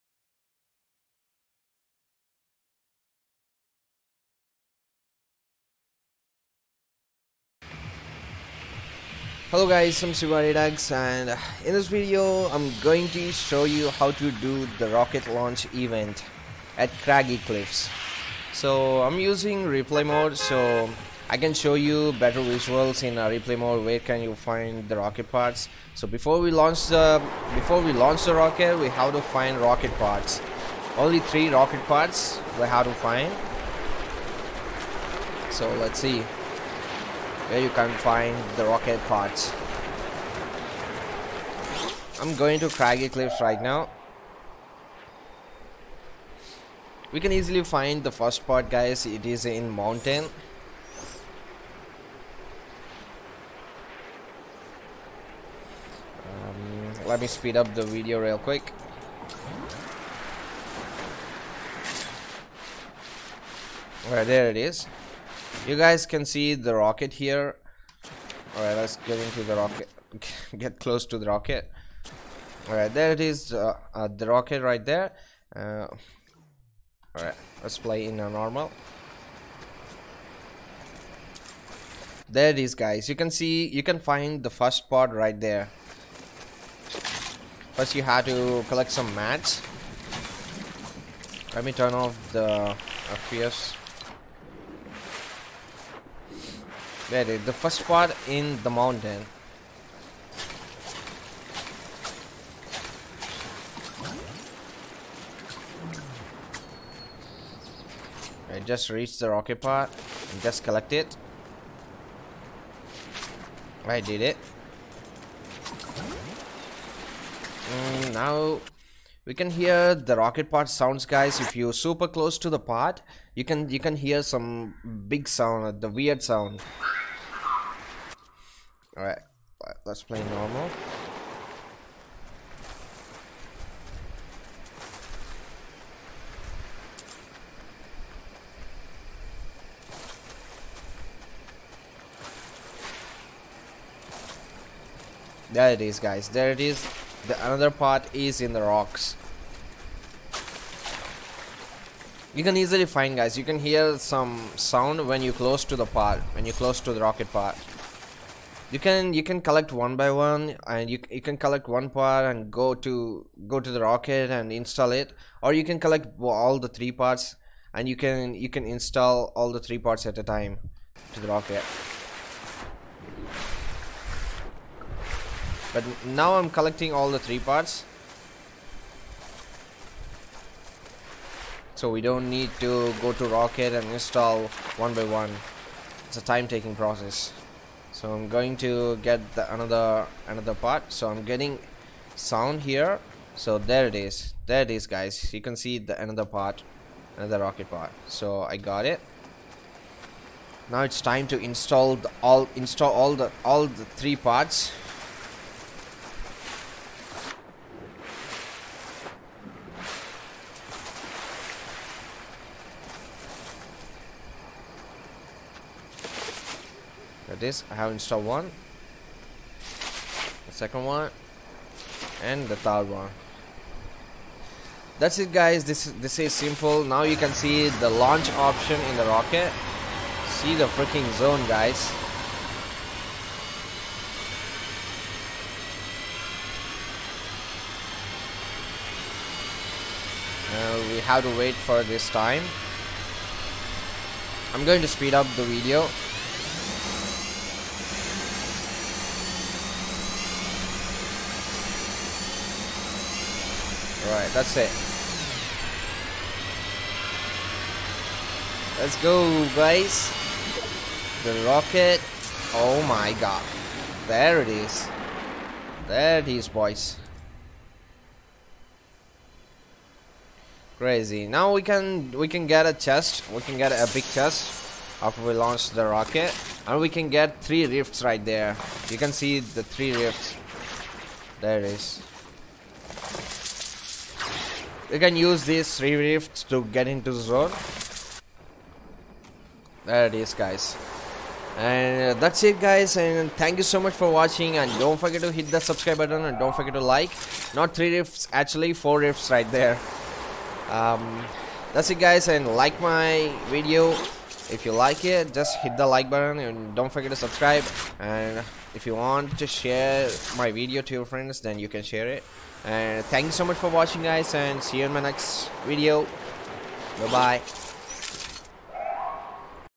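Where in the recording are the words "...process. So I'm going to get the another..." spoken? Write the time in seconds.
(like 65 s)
186 s.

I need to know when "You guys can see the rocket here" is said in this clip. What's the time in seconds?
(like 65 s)
65 s.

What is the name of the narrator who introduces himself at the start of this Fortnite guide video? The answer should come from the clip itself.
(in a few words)
CVA Redux.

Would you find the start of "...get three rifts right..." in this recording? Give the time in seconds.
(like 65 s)
277 s.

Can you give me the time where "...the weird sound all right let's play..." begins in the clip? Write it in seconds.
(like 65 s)
125 s.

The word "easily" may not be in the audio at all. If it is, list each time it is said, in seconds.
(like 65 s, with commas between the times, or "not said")
47 s, 152 s.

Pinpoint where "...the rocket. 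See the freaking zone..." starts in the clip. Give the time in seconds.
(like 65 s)
228 s.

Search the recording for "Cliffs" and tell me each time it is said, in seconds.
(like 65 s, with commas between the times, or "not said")
17 s, 43 s.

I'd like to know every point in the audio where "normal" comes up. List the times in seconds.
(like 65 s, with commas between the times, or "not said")
78 s, 130 s.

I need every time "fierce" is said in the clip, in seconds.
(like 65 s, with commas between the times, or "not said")
93 s.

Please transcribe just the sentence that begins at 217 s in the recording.
I have installed one, the second one, and the third one.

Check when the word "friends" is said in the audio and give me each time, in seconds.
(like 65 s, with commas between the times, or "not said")
311 s.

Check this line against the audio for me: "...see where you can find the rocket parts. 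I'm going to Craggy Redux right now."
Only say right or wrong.
wrong.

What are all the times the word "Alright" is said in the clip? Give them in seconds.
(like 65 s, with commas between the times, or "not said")
64 s, 68 s, 72 s, 77 s.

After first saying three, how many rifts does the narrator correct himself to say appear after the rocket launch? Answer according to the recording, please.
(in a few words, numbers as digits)
4.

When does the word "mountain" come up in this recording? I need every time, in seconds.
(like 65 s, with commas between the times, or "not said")
49 s, 98 s.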